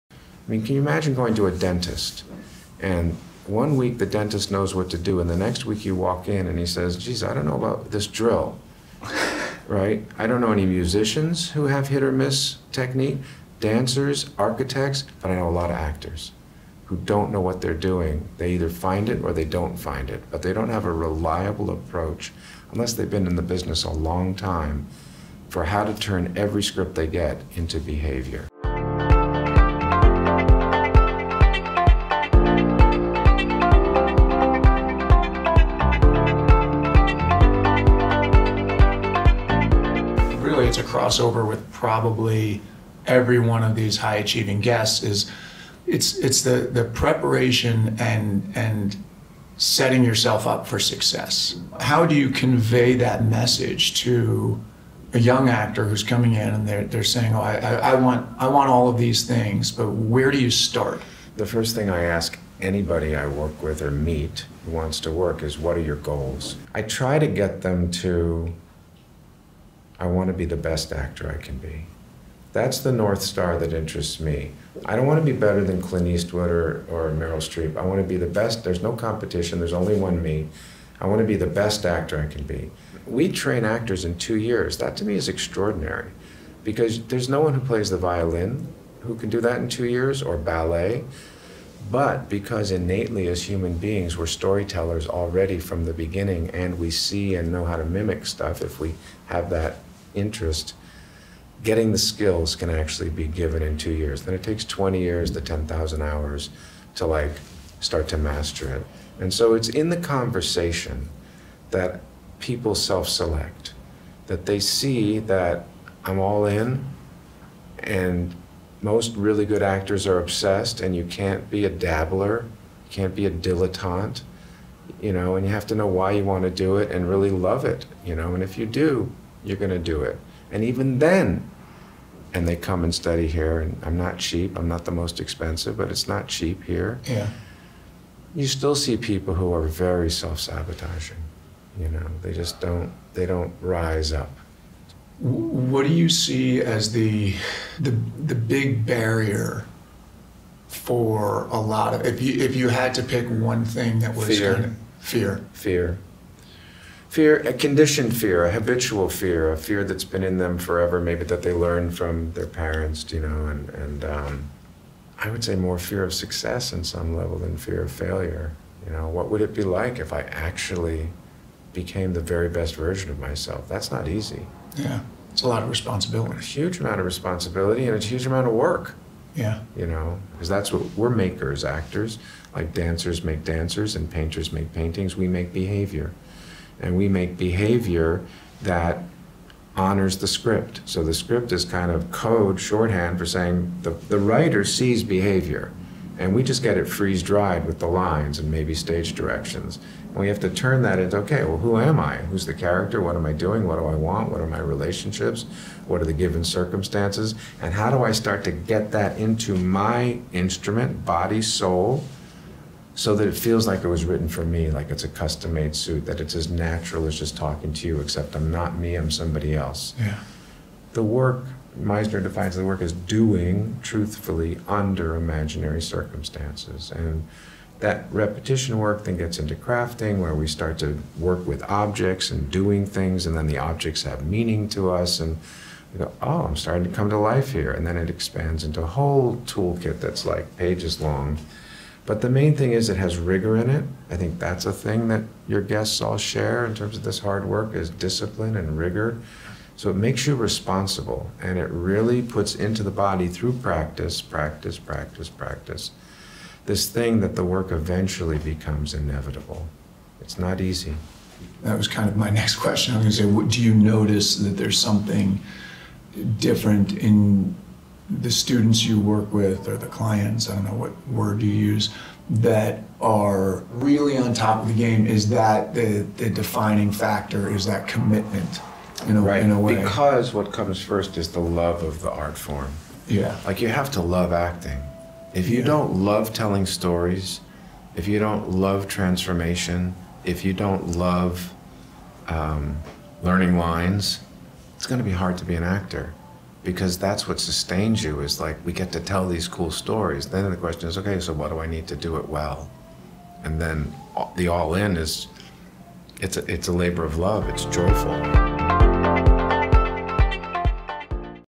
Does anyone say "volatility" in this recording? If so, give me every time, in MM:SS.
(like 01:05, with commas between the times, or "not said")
not said.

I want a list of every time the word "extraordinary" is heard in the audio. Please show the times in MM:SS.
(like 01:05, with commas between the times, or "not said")
01:25.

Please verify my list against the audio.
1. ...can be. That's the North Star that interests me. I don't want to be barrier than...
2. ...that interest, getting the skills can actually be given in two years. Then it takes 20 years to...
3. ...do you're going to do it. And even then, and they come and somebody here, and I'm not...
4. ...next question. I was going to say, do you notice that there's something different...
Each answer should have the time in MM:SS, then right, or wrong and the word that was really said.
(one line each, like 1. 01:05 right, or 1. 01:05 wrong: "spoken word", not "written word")
1. 01:11 wrong: "better", not "barrier"
2. 01:39 right
3. 02:08 wrong: "study", not "somebody"
4. 04:22 right.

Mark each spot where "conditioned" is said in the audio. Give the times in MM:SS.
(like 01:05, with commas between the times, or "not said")
02:37.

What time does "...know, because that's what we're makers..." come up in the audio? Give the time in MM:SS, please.
02:59.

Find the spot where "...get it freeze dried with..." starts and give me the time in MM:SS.
03:16.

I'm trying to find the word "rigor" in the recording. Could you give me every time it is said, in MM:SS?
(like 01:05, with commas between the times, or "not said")
04:03, 04:08.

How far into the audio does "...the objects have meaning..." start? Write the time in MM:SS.
03:53.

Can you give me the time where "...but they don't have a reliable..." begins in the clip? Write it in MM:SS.
00:20.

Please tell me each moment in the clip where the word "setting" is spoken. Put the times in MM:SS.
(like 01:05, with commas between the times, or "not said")
00:49.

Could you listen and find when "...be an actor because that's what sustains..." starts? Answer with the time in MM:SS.
04:55.